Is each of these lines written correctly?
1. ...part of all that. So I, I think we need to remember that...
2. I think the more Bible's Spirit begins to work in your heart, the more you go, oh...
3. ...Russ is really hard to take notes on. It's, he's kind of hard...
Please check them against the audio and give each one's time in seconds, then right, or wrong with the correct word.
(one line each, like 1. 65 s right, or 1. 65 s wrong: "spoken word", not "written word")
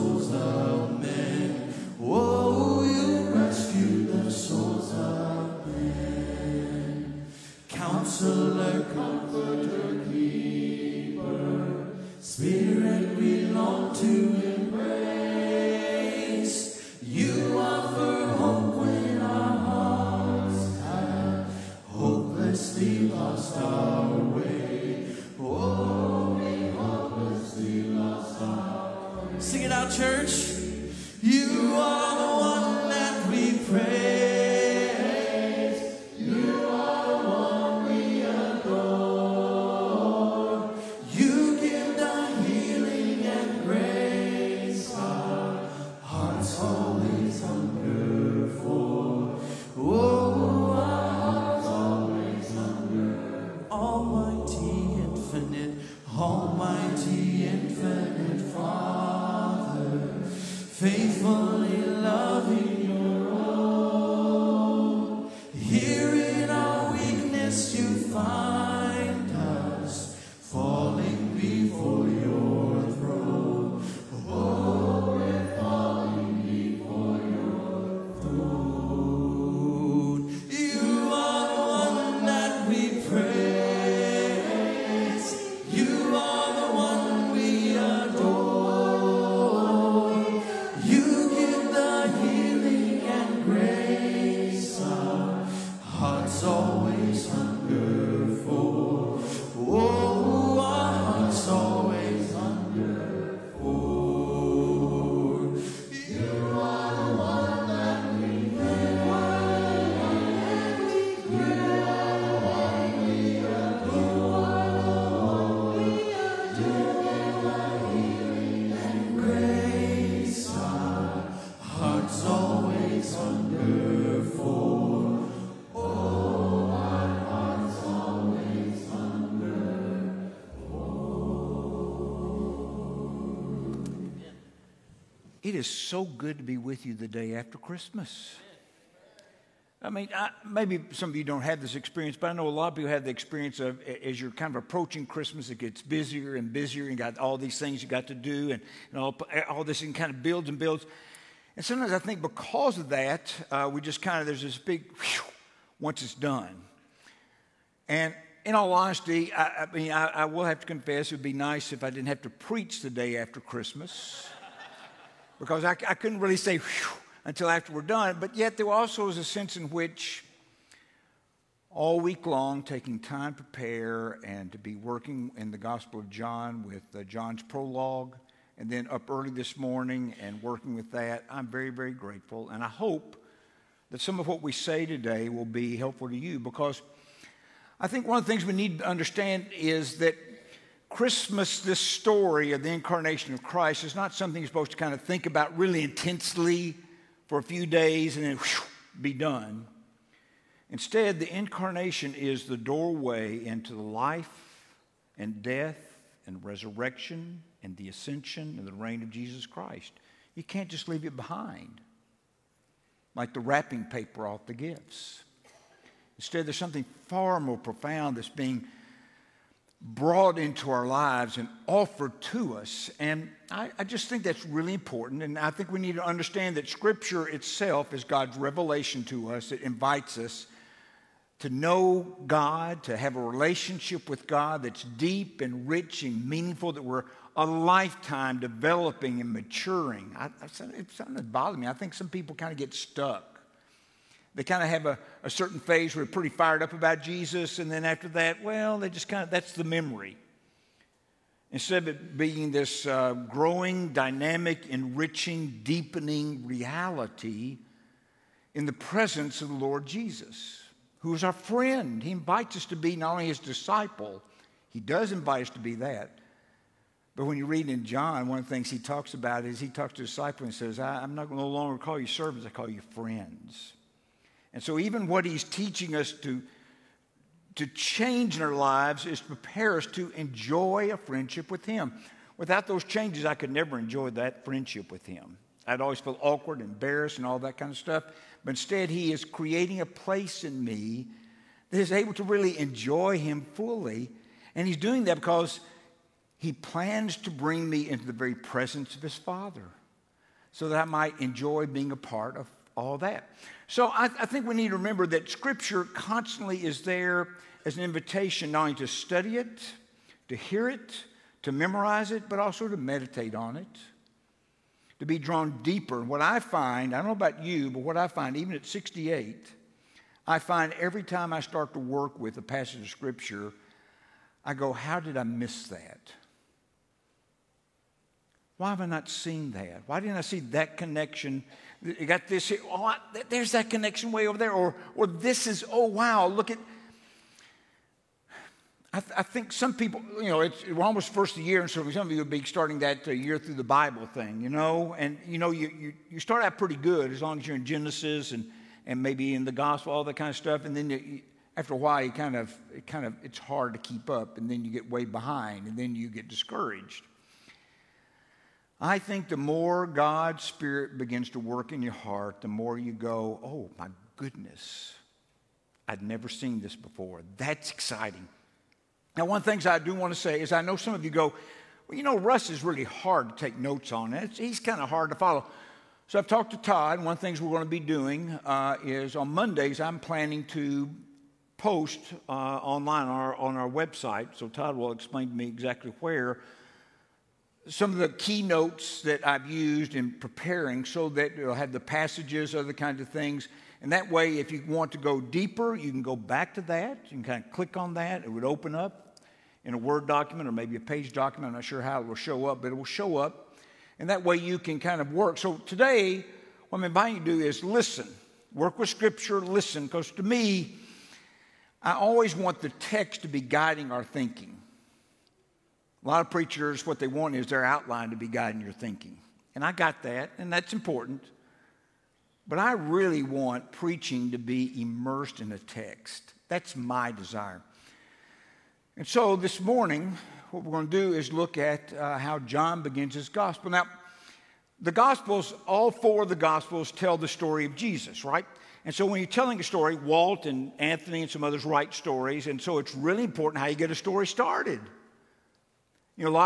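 1. 301 s right
2. 358 s wrong: "God", not "Bible"
3. 372 s right.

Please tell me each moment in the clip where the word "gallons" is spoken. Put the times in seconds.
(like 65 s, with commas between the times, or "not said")
not said.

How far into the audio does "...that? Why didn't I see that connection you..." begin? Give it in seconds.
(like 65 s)
329 s.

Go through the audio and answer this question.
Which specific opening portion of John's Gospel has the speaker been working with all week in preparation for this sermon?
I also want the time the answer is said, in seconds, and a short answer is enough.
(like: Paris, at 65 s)
John's prologue, at 177 s.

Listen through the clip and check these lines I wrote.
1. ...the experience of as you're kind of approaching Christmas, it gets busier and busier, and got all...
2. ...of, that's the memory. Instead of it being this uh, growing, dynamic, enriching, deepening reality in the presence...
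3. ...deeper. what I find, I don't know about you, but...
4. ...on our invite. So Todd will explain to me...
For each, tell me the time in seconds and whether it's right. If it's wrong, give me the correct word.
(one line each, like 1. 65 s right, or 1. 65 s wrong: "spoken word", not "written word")
1. 143 s right
2. 249 s right
3. 315 s right
4. 383 s wrong: "website", not "invite".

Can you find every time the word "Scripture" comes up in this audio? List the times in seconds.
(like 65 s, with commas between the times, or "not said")
226 s, 305 s, 322 s, 408 s.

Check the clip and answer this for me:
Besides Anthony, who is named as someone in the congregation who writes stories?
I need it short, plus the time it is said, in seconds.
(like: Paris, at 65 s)
Walt, at 439 s.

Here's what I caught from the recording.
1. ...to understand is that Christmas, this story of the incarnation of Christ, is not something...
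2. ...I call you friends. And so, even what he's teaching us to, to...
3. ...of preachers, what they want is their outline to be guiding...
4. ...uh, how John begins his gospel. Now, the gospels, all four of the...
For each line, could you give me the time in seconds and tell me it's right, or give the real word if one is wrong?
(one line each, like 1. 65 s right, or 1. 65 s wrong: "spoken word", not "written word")
1. 188 s right
2. 272 s right
3. 416 s right
4. 431 s right.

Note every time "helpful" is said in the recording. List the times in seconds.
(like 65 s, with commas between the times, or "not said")
185 s.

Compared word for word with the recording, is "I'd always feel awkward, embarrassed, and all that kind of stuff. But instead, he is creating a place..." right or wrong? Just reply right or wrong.
right.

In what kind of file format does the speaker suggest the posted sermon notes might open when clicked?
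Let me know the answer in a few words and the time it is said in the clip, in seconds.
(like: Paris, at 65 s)
Word document, at 399 s.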